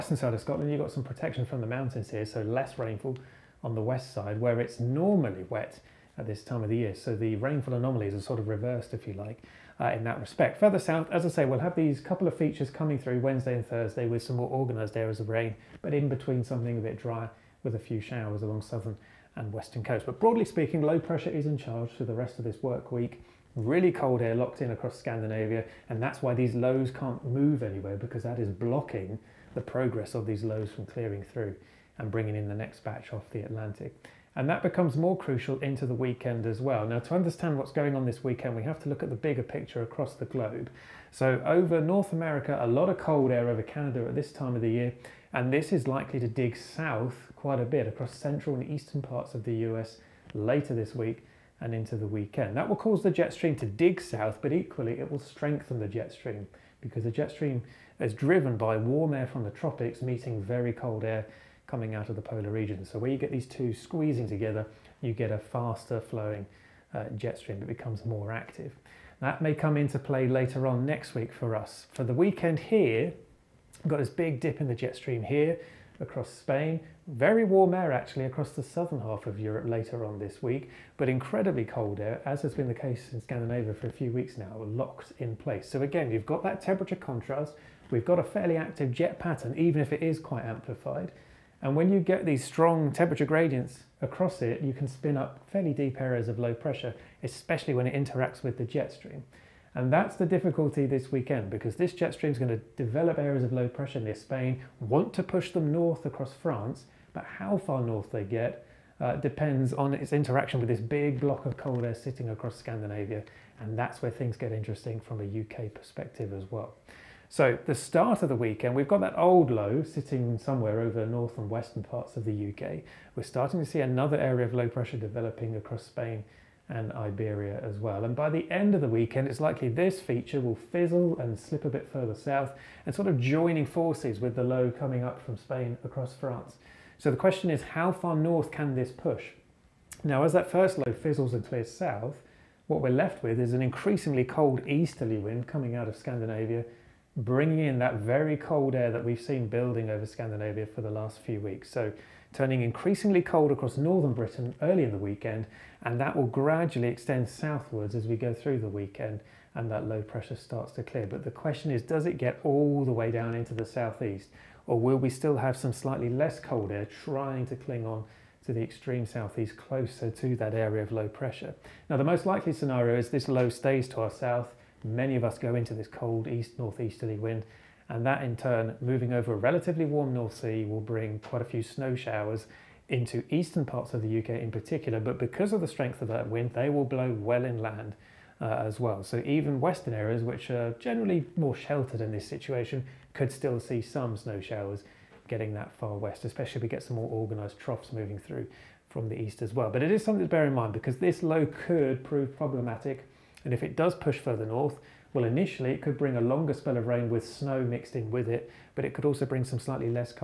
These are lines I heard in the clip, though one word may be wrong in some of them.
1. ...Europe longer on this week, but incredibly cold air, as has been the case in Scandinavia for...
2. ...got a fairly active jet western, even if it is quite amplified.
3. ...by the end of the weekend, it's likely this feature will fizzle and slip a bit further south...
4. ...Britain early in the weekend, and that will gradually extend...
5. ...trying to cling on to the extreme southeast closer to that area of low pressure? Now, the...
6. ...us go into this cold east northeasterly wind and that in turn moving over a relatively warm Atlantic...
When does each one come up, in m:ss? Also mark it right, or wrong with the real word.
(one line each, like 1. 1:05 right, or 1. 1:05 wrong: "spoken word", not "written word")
1. 1:19 wrong: "later", not "longer"
2. 1:28 wrong: "pattern", not "western"
3. 2:08 right
4. 2:34 right
5. 2:47 right
6. 2:55 wrong: "North", not "Atlantic".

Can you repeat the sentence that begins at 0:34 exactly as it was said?
And that becomes more crucial into the weekend as well.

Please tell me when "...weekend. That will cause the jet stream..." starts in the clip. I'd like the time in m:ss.
0:52.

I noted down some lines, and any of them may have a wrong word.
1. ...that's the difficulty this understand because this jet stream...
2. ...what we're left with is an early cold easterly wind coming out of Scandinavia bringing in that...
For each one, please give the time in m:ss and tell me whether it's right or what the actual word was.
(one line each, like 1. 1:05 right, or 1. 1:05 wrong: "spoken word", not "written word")
1. 1:39 wrong: "weekend", not "understand"
2. 2:22 wrong: "increasingly", not "early".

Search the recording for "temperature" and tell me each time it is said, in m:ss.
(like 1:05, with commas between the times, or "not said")
1:26, 1:32.